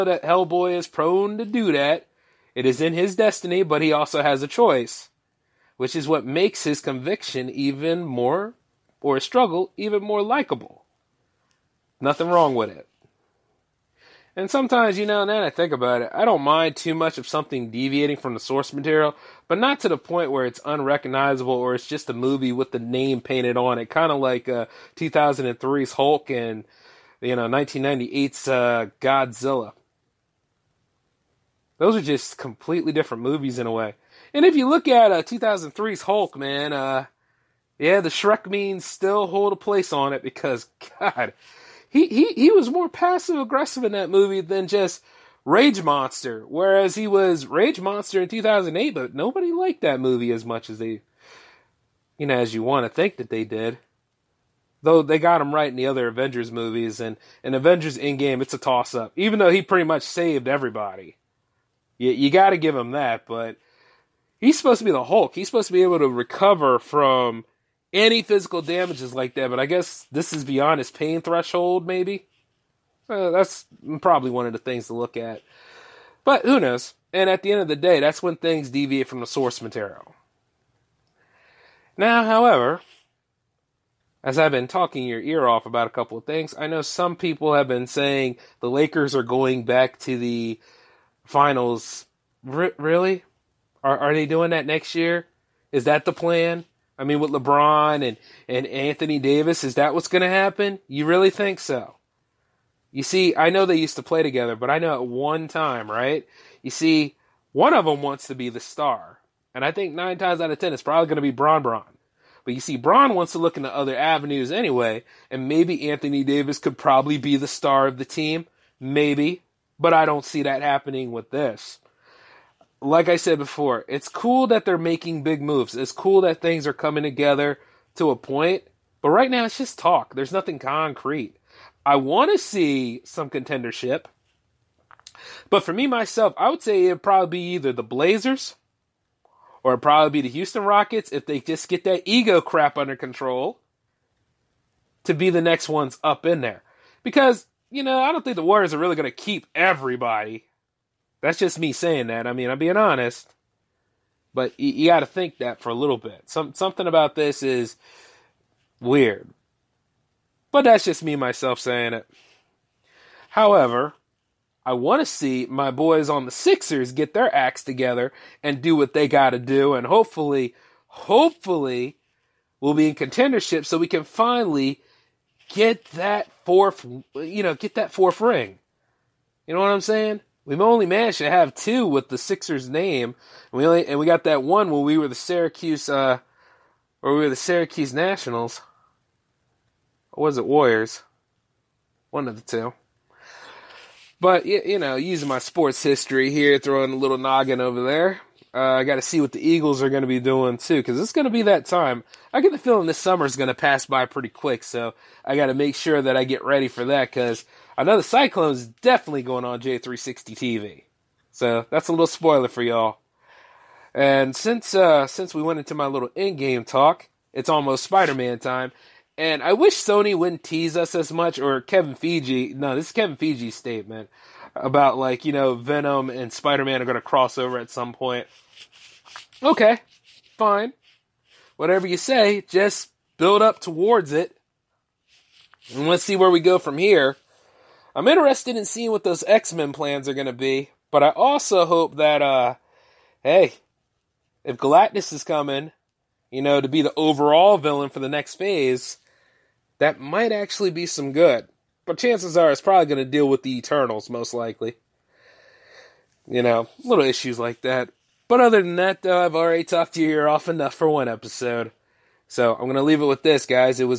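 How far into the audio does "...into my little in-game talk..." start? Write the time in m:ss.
3:35.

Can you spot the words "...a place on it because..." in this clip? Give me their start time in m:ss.
0:39.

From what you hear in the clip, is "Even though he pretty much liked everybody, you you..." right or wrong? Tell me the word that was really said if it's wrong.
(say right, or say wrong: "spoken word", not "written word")
wrong: "saved", not "liked".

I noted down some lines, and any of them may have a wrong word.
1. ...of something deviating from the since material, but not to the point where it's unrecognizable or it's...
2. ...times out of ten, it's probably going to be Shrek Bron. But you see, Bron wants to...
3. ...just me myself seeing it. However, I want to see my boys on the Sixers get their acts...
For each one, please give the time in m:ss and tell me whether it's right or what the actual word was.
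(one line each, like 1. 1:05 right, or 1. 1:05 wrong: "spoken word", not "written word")
1. 0:17 wrong: "source", not "since"
2. 1:50 wrong: "Bron", not "Shrek"
3. 2:40 wrong: "saying", not "seeing".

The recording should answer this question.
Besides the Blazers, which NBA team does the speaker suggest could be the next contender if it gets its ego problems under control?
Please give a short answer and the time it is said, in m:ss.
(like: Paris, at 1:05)
Houston Rockets, at 2:20.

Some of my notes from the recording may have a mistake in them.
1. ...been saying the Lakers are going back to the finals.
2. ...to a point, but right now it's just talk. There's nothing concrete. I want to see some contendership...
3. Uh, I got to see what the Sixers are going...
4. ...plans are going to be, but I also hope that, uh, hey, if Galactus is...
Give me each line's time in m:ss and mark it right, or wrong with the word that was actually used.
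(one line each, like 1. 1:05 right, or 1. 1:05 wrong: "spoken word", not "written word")
1. 1:27 right
2. 2:07 right
3. 3:18 wrong: "Eagles", not "Sixers"
4. 3:59 right.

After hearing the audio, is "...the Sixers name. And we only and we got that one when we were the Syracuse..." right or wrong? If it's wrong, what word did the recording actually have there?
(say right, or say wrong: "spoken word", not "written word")
right.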